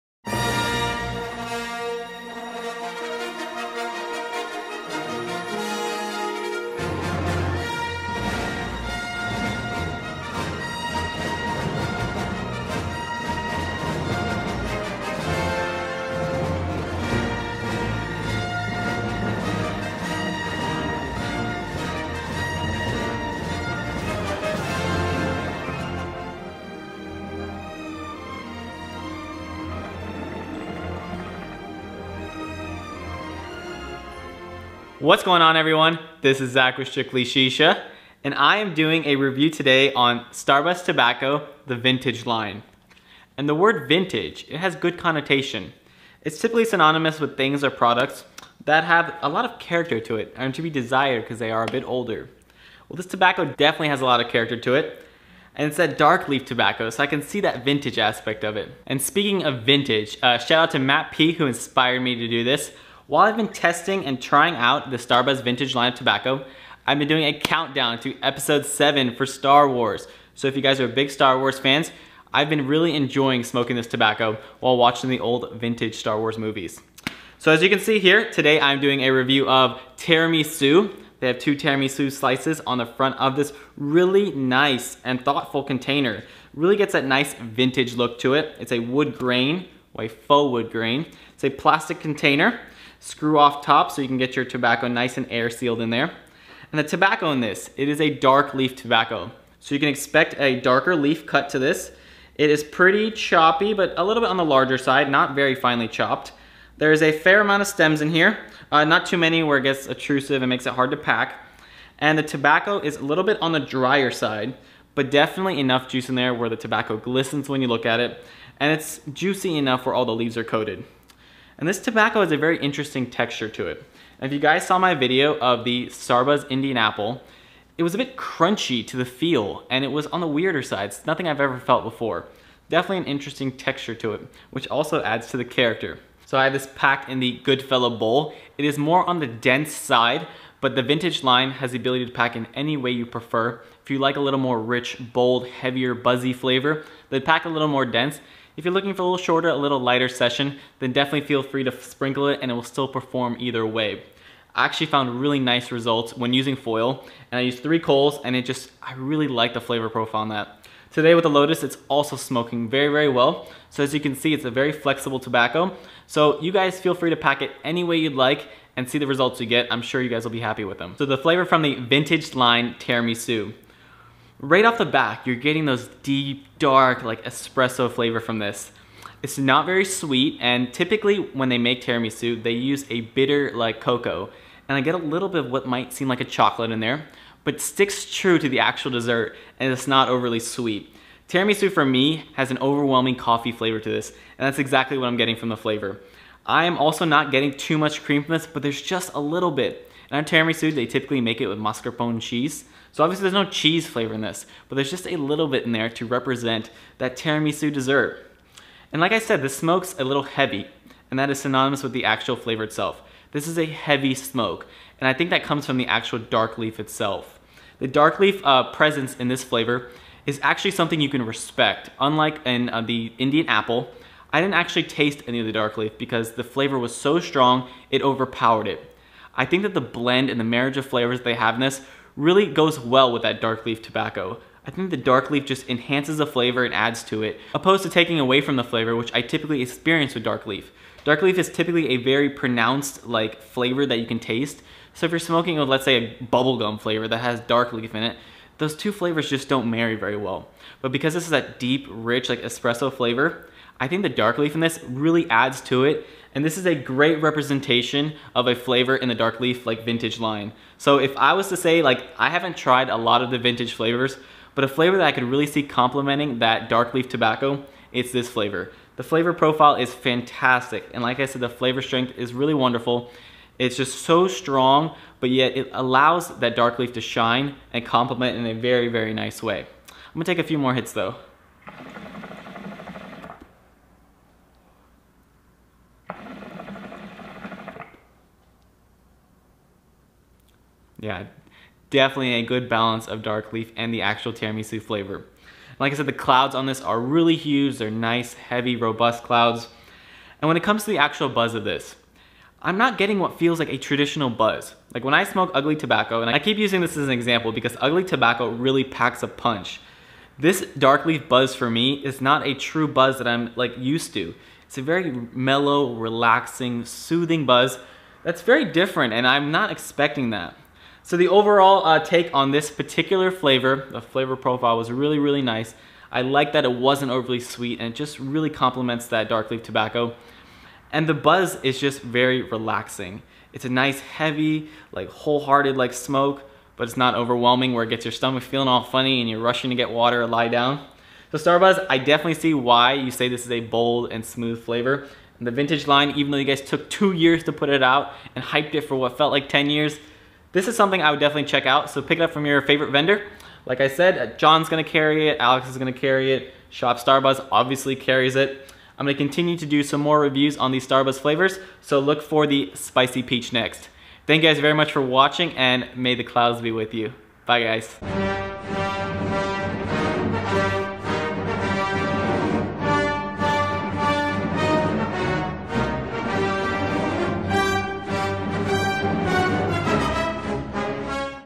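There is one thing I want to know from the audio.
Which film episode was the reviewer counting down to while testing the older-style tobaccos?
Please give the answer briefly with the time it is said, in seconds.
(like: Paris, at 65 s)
Episode 7, at 68 s.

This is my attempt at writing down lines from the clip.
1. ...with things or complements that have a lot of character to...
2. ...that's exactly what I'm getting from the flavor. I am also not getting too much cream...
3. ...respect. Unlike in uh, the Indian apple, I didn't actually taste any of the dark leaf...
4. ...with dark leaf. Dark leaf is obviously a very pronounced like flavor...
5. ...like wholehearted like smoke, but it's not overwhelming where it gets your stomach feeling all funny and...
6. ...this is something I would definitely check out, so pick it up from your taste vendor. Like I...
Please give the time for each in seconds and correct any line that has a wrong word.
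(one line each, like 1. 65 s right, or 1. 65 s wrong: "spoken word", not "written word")
1. 47 s wrong: "products", not "complements"
2. 194 s right
3. 221 s right
4. 240 s wrong: "typically", not "obviously"
5. 334 s right
6. 350 s wrong: "favorite", not "taste".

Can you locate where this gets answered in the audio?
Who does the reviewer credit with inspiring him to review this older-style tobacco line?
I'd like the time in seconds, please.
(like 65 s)
60 s.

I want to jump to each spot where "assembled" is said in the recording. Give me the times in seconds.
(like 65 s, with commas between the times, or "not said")
not said.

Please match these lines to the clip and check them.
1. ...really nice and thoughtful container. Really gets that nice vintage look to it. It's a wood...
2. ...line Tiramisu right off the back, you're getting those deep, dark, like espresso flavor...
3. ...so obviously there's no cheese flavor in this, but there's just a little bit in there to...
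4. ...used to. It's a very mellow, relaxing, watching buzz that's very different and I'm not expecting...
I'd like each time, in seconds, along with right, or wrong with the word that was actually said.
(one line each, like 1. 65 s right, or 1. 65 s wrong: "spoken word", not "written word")
1. 83 s right
2. 172 s right
3. 202 s right
4. 313 s wrong: "soothing", not "watching".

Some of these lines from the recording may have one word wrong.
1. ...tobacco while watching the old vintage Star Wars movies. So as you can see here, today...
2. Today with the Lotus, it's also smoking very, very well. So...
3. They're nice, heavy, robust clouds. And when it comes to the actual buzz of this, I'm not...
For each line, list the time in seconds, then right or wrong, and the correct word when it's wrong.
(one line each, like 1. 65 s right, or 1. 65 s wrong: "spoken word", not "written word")
1. 73 s right
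2. 160 s right
3. 297 s right.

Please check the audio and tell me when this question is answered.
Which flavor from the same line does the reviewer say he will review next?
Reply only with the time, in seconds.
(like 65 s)
362 s.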